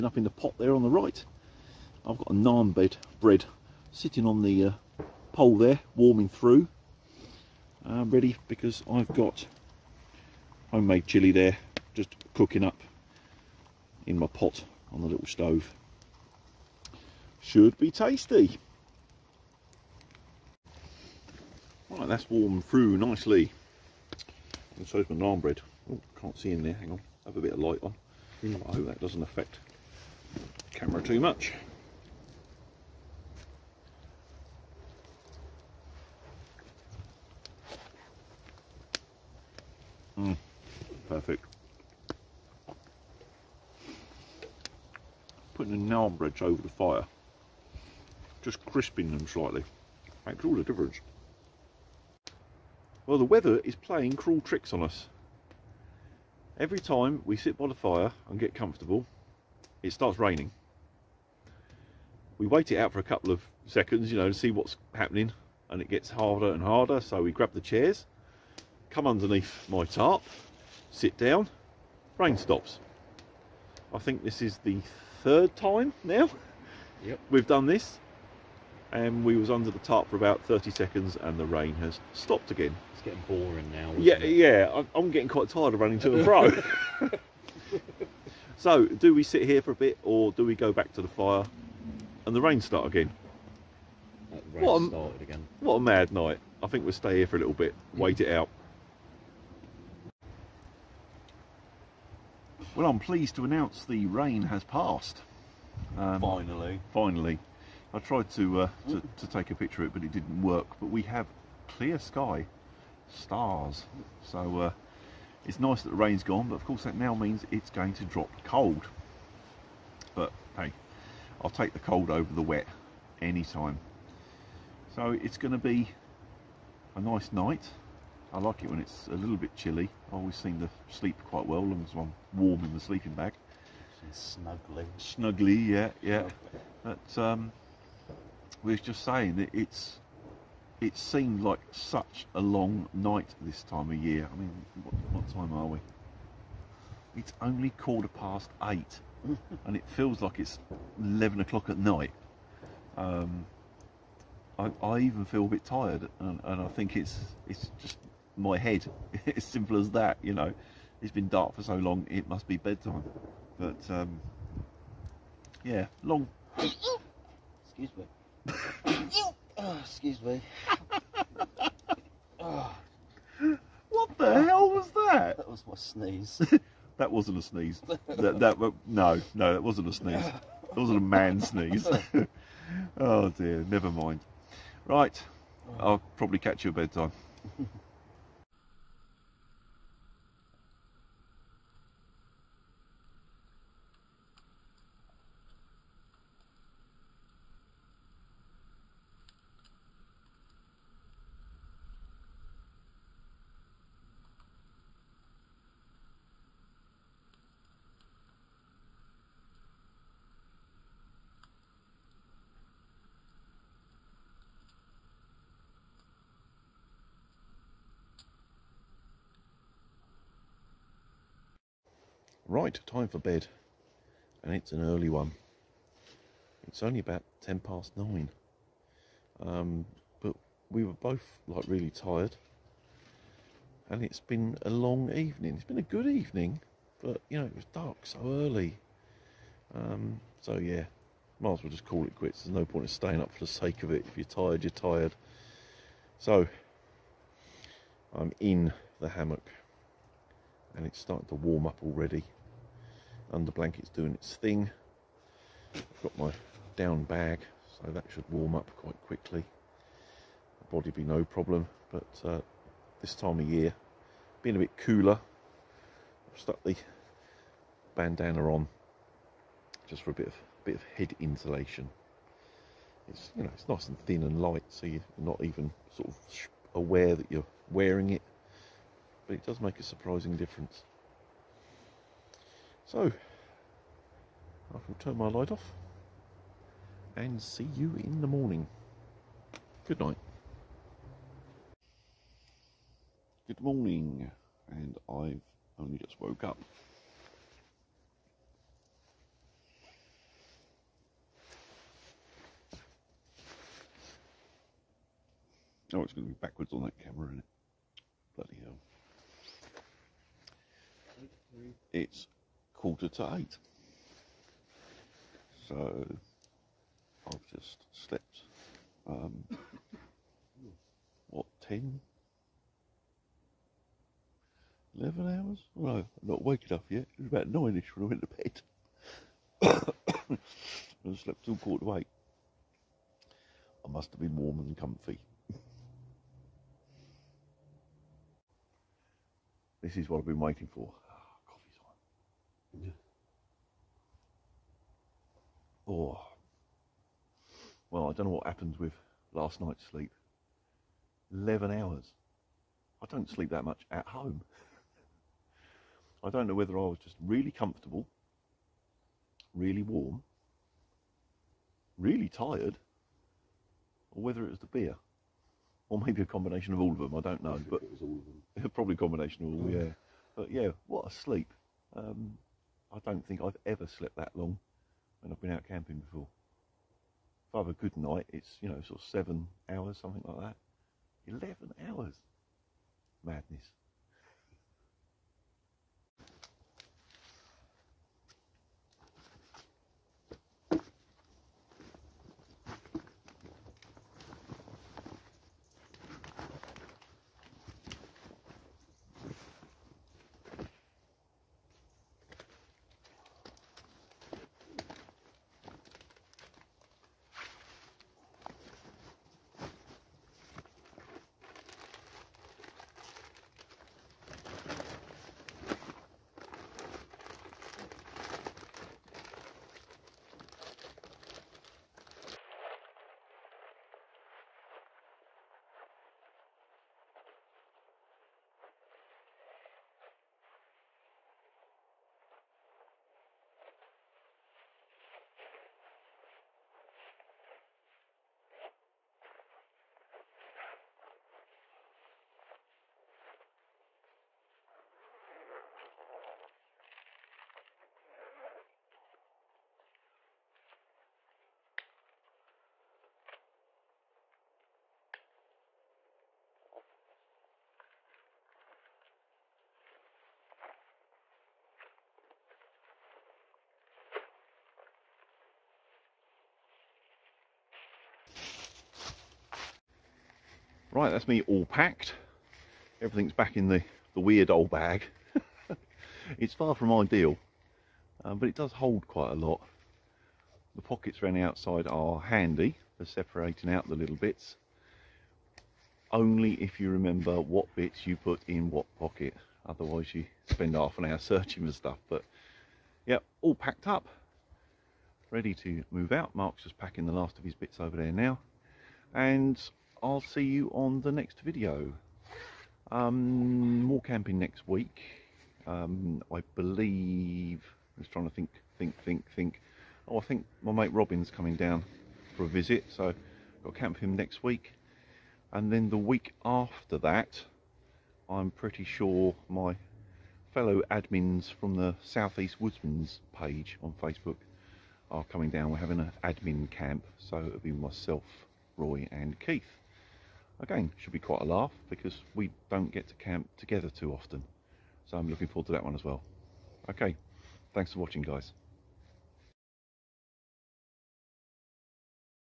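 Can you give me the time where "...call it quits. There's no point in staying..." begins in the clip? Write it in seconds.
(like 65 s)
241 s.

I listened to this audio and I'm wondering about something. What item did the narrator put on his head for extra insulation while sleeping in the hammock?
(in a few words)
Bandana.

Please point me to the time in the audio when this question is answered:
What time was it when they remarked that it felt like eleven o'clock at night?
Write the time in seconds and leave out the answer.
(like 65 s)
147 s.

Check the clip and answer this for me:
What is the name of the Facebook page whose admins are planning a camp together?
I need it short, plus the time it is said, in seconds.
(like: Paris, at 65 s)
Southeast Woodsman's, at 522 s.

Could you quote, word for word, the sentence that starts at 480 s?
The pockets around the outside are handy for separating out the little bits.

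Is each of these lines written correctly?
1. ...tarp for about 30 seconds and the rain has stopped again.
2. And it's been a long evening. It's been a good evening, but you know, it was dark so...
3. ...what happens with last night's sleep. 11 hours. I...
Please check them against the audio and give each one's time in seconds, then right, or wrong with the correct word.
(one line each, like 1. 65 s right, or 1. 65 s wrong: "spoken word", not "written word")
1. 79 s right
2. 233 s right
3. 348 s right.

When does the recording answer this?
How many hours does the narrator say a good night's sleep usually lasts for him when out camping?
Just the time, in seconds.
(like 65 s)
379 s.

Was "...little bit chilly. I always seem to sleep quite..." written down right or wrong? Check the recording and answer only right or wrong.
right.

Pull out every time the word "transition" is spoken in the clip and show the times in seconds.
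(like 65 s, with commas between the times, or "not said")
not said.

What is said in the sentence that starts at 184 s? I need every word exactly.
Right, I'll probably catch you at bedtime.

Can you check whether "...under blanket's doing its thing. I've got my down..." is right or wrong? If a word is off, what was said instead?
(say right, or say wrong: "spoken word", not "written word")
right.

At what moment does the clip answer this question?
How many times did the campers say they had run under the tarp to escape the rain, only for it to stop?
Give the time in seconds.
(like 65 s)
75 s.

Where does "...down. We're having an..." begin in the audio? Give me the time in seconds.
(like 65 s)
525 s.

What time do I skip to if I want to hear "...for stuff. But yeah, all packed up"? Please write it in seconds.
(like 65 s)
491 s.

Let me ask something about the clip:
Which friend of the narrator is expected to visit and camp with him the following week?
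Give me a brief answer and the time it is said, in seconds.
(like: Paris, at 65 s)
Robin, at 510 s.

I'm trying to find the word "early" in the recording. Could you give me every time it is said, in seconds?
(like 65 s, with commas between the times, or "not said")
224 s, 238 s.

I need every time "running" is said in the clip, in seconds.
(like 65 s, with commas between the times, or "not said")
85 s.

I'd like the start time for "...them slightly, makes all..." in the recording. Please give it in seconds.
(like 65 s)
49 s.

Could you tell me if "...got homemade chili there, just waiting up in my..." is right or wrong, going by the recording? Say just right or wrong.
wrong.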